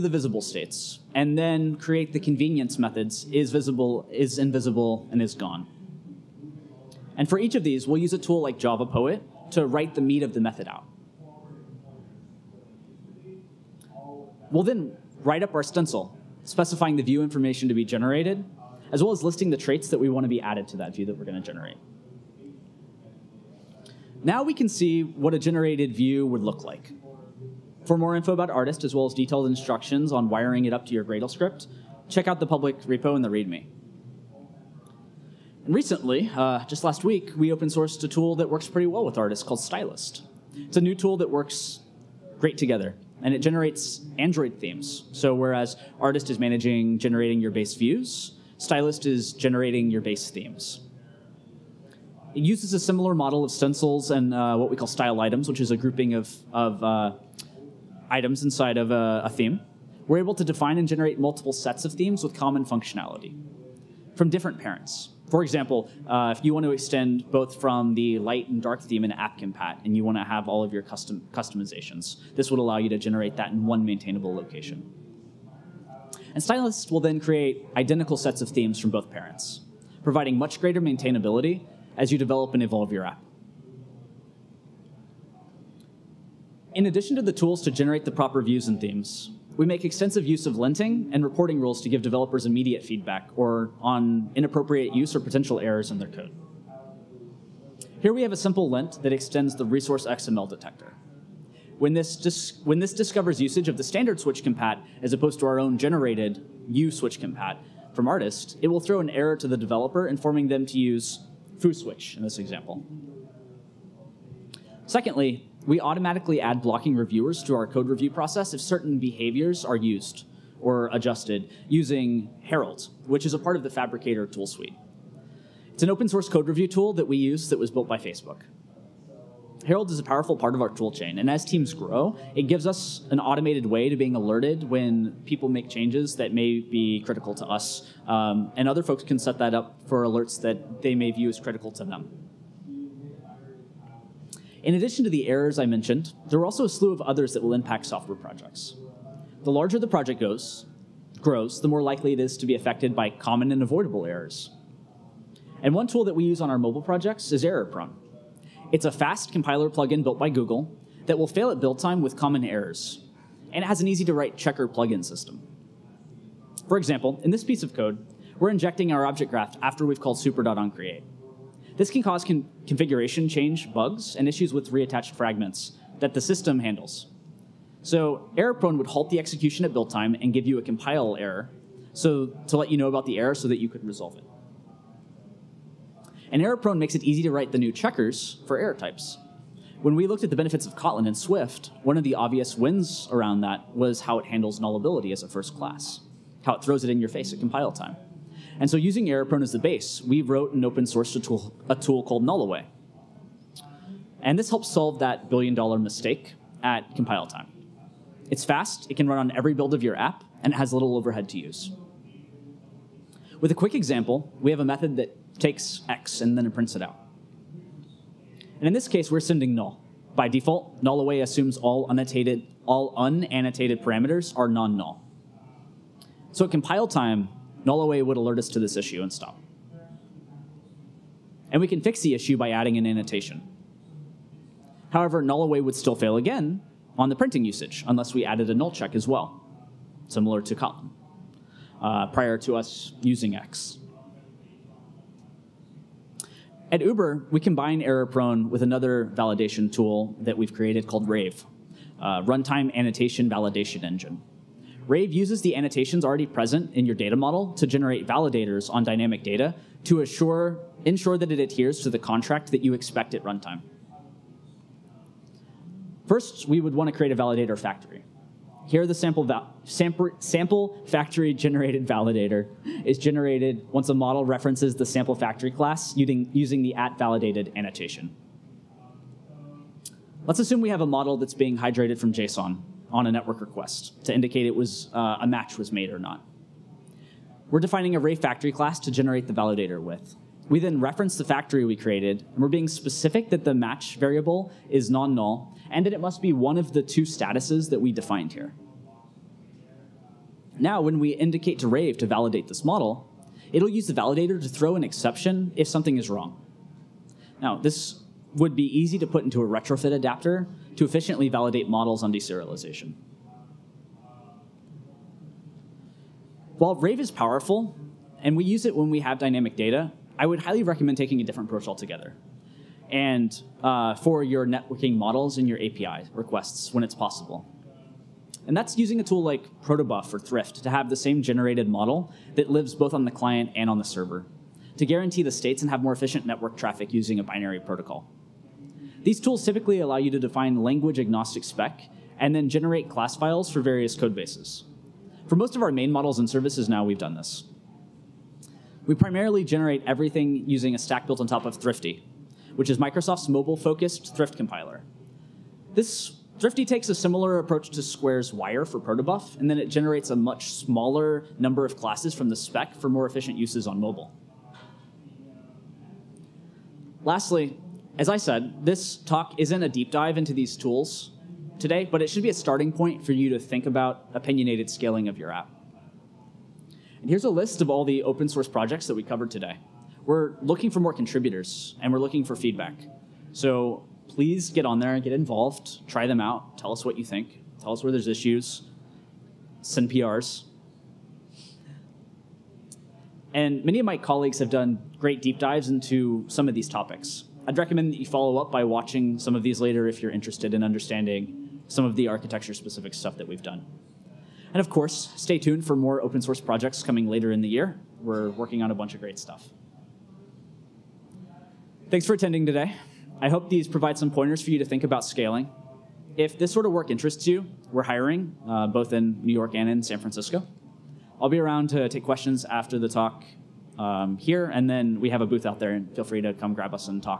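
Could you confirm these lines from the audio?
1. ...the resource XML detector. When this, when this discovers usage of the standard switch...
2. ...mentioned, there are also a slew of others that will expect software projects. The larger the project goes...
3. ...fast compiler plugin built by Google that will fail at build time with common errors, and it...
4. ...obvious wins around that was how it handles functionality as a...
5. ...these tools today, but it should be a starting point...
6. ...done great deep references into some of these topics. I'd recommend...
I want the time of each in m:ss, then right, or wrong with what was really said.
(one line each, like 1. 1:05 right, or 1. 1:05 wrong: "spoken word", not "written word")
1. 1:39 right
2. 2:25 wrong: "impact", not "expect"
3. 2:38 right
4. 3:12 wrong: "nullability", not "functionality"
5. 6:10 right
6. 6:34 wrong: "dives", not "references".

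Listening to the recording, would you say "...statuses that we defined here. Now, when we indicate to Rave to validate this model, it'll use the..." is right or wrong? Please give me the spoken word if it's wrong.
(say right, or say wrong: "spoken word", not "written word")
right.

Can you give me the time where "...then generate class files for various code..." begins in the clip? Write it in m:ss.
5:42.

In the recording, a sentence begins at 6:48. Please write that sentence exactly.
We're working on a bunch of great stuff.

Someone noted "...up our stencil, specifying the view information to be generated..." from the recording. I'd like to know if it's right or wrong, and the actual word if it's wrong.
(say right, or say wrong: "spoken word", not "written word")
right.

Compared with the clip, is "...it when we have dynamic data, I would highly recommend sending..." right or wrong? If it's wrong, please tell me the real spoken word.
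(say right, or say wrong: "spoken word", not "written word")
wrong: "taking", not "sending".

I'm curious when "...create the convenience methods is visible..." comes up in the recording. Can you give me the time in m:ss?
0:01.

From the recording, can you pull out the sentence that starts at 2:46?
For example, in this piece of code, we're injecting our object graph after we've called super.onCreate.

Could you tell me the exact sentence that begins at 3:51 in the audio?
And we can fix the issue by adding an annotation.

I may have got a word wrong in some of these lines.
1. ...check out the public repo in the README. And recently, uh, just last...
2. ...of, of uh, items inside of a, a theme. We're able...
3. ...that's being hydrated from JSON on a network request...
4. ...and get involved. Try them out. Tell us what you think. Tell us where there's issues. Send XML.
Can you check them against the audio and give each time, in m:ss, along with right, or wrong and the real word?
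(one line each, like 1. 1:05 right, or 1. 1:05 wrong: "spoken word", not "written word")
1. 0:32 right
2. 0:56 right
3. 4:41 right
4. 6:24 wrong: "PRs", not "XML".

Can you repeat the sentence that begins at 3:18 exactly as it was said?
And so using error prone as the base, we wrote and open sourced a tool, a tool called Nullaway.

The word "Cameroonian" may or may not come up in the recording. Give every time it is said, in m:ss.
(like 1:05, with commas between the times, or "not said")
not said.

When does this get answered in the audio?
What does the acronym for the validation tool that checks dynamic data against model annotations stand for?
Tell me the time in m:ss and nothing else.
4:12.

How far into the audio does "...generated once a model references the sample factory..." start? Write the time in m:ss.
4:32.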